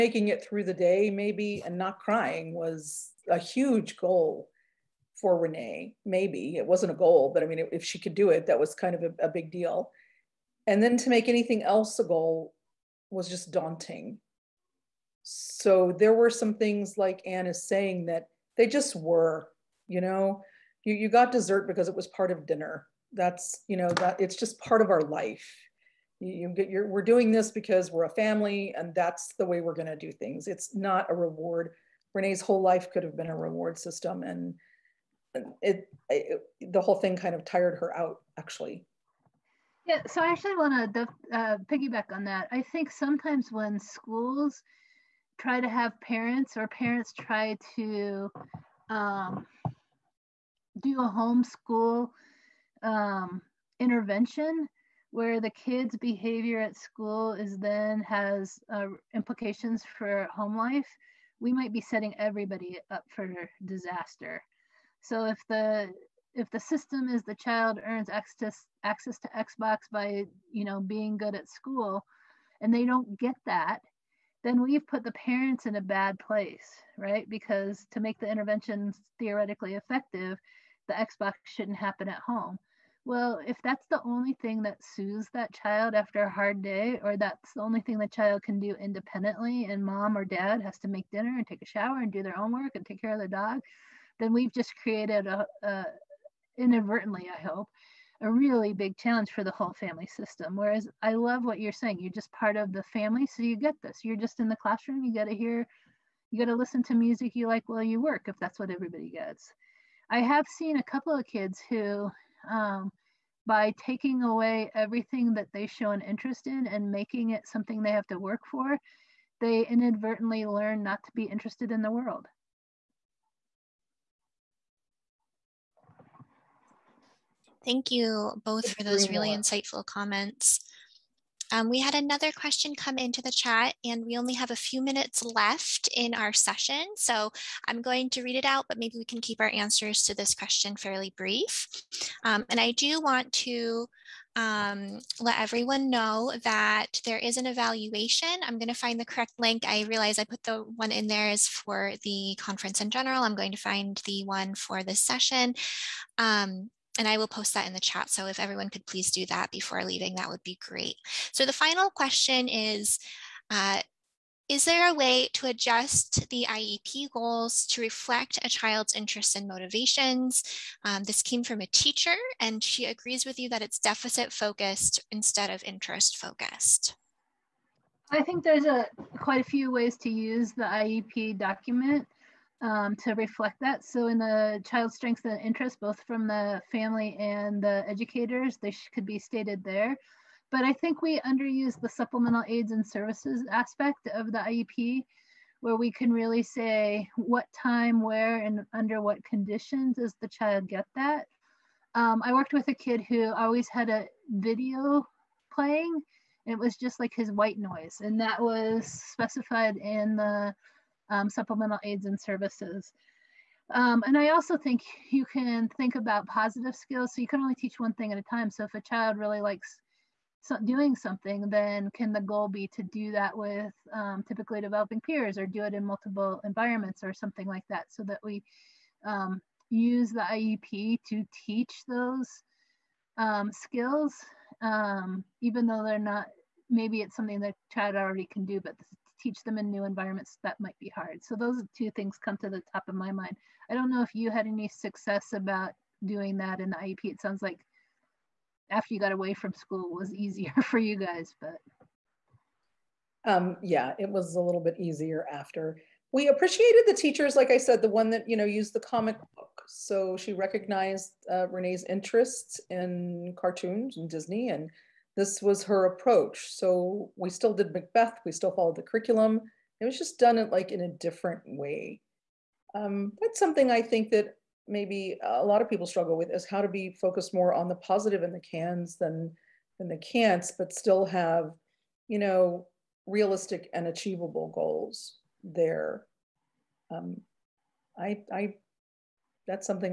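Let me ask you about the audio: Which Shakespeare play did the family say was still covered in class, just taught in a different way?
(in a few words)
Macbeth.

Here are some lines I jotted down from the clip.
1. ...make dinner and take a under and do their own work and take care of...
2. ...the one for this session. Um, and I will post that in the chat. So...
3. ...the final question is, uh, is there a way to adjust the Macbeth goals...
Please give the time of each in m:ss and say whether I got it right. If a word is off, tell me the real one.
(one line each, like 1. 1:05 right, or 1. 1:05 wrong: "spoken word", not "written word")
1. 1:30 wrong: "shower", not "under"
2. 2:34 right
3. 2:41 wrong: "IEP", not "Macbeth".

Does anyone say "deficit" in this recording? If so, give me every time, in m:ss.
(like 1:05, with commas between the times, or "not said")
2:53.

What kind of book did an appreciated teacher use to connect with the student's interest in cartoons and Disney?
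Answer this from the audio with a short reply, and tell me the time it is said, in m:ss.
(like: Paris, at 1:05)
comic book, at 4:18.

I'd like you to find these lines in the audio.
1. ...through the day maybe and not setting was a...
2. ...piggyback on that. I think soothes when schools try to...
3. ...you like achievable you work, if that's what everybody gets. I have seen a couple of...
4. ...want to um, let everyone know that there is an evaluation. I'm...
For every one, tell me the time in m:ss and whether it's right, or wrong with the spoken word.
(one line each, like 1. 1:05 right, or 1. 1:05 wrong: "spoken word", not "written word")
1. 0:00 wrong: "crying", not "setting"
2. 0:41 wrong: "sometimes", not "soothes"
3. 1:47 wrong: "while", not "achievable"
4. 2:23 right.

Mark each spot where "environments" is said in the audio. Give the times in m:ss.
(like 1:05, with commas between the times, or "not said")
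3:46, 3:59.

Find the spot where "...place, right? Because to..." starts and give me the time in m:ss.
1:16.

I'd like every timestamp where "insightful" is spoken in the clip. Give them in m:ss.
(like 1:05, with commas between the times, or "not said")
2:09.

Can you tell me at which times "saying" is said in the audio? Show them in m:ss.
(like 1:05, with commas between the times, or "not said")
0:17, 1:41.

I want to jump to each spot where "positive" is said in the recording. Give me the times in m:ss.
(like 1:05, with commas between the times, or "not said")
3:36, 4:37.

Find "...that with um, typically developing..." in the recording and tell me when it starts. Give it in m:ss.
3:43.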